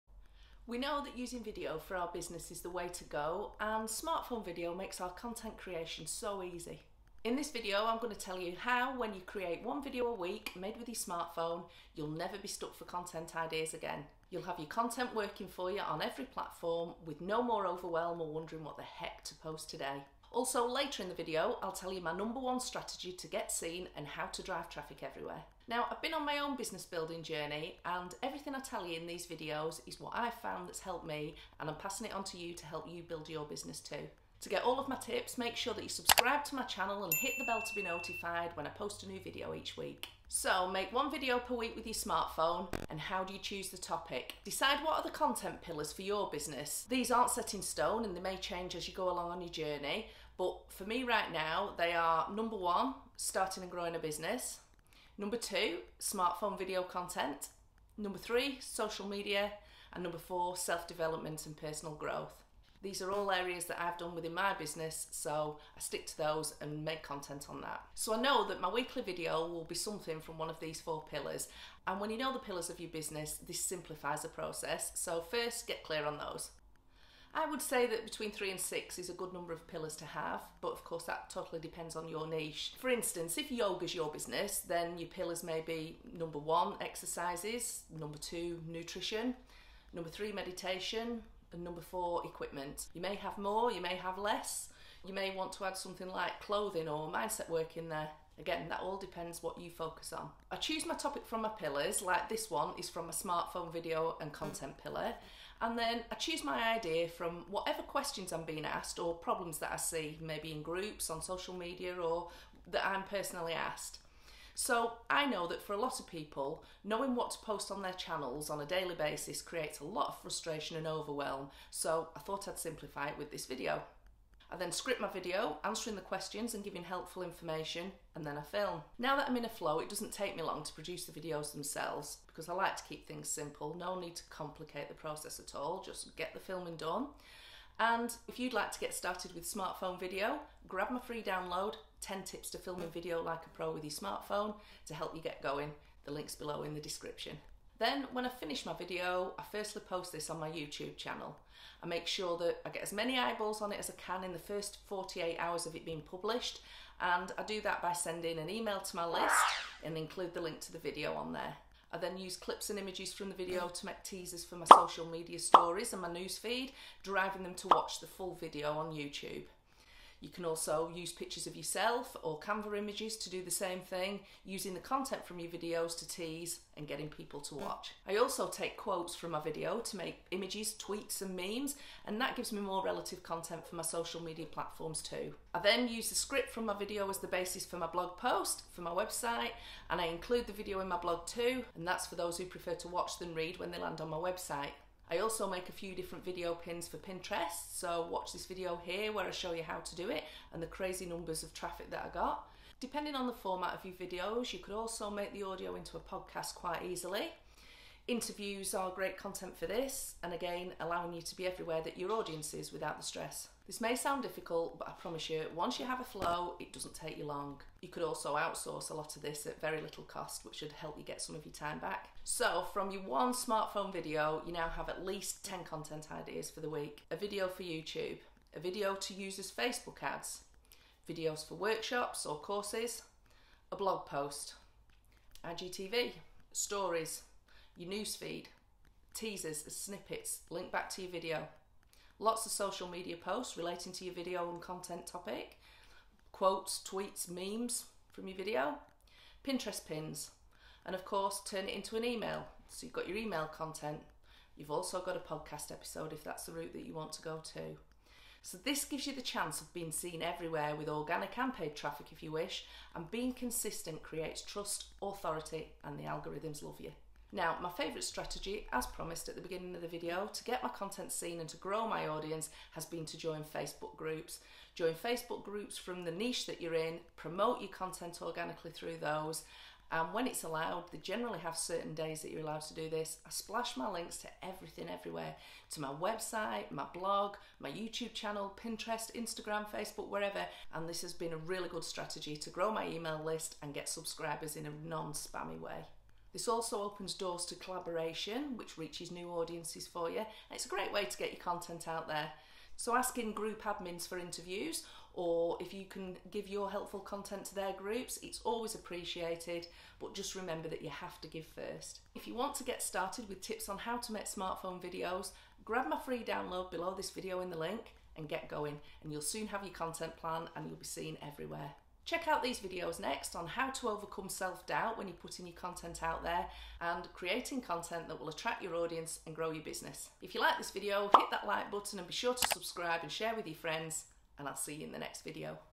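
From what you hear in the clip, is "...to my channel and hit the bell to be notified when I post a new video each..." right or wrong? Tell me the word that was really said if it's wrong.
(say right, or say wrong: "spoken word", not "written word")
right.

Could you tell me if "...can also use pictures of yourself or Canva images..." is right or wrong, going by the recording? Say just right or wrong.
right.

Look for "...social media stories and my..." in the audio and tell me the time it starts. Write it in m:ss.
2:44.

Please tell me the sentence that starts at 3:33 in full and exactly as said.
This may sound difficult, but I promise you, once you have a flow, it doesn't take you long.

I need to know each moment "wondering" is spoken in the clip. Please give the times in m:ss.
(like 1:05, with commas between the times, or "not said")
0:18.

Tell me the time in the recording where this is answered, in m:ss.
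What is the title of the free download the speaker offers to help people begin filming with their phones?
2:22.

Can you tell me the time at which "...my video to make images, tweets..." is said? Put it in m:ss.
2:59.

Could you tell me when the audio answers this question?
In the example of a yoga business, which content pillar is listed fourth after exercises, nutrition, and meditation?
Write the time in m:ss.
1:32.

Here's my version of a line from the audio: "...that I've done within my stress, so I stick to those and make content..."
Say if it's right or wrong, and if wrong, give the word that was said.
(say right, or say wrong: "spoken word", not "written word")
wrong: "business", not "stress".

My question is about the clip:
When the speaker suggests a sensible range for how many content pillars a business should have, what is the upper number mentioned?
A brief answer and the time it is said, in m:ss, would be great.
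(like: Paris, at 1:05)
6, at 1:18.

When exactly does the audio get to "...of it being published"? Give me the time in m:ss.
2:35.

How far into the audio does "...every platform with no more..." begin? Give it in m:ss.
0:16.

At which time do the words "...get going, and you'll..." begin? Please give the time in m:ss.
5:18.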